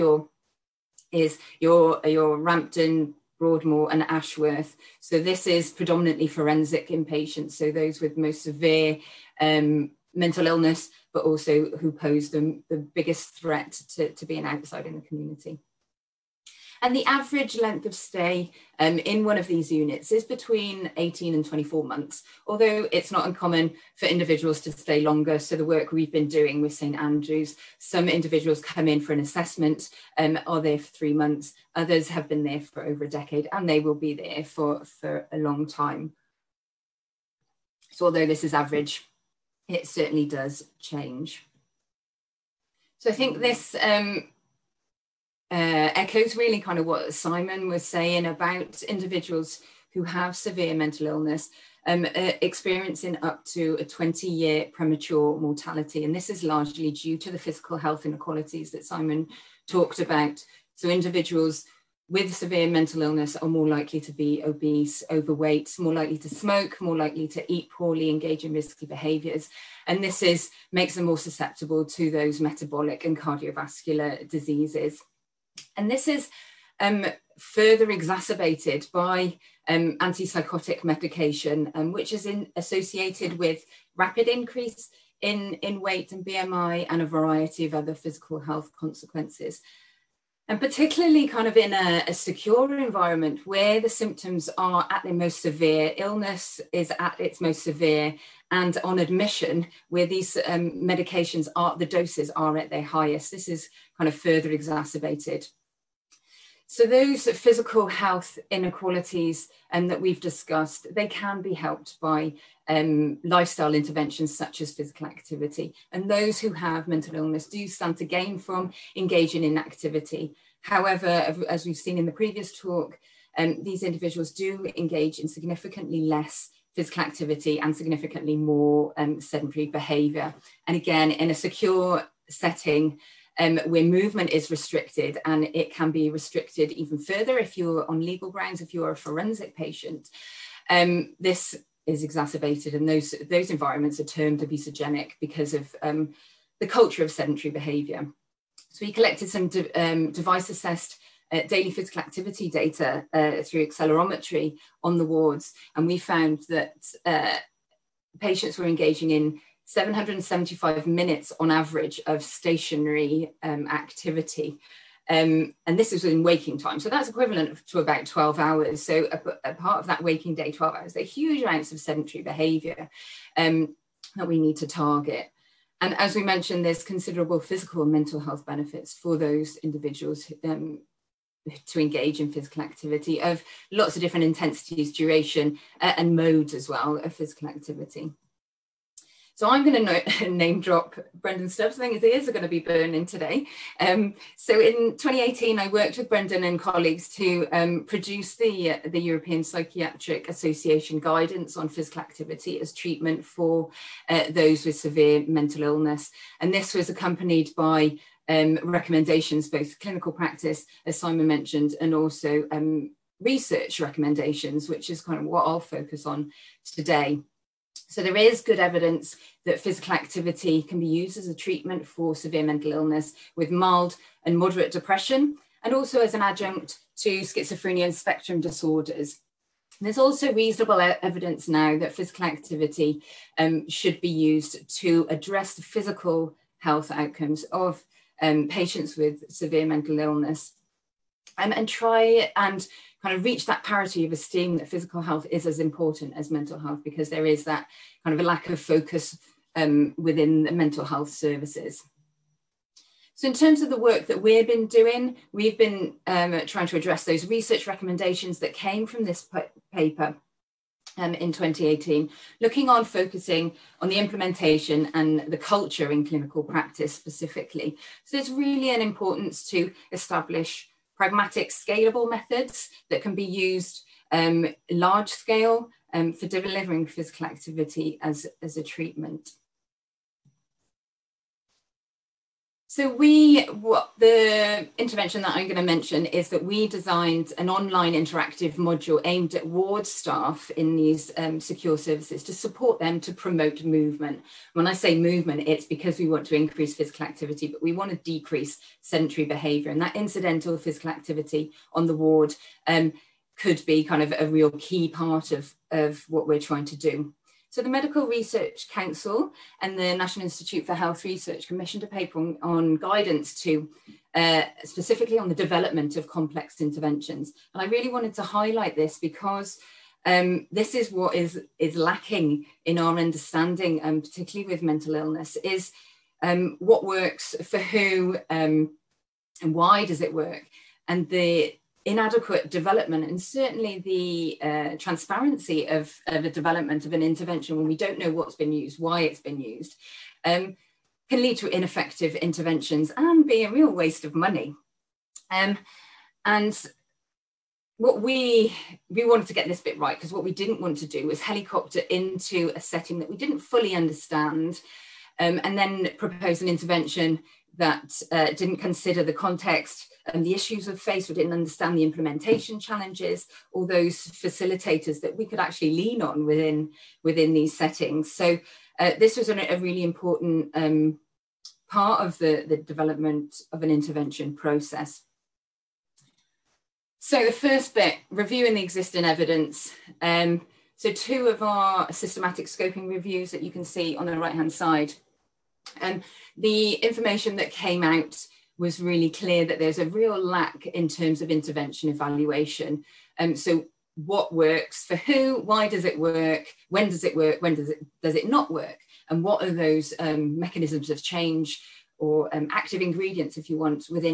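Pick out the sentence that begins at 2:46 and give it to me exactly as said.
So that's equivalent to about 12 hours.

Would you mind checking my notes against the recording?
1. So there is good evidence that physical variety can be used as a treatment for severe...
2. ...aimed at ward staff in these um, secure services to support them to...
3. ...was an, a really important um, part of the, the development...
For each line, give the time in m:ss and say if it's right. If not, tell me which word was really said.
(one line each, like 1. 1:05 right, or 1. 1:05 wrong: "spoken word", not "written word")
1. 3:37 wrong: "activity", not "variety"
2. 4:49 right
3. 6:09 right.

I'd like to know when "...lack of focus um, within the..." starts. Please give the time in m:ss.
4:08.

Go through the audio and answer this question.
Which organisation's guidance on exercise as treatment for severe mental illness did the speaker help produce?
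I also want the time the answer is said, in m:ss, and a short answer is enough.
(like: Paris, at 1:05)
European Psychiatric Association, at 3:19.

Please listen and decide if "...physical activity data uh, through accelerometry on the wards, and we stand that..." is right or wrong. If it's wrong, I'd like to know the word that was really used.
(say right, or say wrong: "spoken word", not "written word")
wrong: "found", not "stand".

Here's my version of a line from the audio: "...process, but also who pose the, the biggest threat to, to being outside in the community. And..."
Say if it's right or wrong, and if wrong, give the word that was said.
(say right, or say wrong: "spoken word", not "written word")
wrong: "illness", not "process".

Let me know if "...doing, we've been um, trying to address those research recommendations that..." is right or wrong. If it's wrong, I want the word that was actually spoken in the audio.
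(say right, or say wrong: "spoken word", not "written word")
right.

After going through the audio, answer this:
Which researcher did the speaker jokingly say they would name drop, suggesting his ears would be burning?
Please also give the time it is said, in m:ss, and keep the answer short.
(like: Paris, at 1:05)
Brendan Stubbs, at 3:11.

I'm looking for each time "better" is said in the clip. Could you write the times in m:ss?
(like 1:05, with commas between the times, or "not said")
not said.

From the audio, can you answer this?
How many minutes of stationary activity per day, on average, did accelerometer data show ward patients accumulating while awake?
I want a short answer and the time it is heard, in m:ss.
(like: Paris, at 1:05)
775, at 2:39.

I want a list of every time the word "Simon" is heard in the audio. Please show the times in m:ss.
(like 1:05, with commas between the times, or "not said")
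0:47, 0:58, 3:30.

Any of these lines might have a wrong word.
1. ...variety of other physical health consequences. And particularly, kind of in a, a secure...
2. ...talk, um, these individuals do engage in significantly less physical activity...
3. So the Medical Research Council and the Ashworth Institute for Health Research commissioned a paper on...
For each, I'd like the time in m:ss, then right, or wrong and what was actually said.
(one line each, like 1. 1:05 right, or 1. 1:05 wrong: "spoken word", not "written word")
1. 1:27 right
2. 2:02 right
3. 5:07 wrong: "National", not "Ashworth".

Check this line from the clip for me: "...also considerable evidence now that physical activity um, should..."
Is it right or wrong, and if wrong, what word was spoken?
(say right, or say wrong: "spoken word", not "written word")
wrong: "reasonable", not "considerable".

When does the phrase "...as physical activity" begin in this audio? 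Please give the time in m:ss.
1:54.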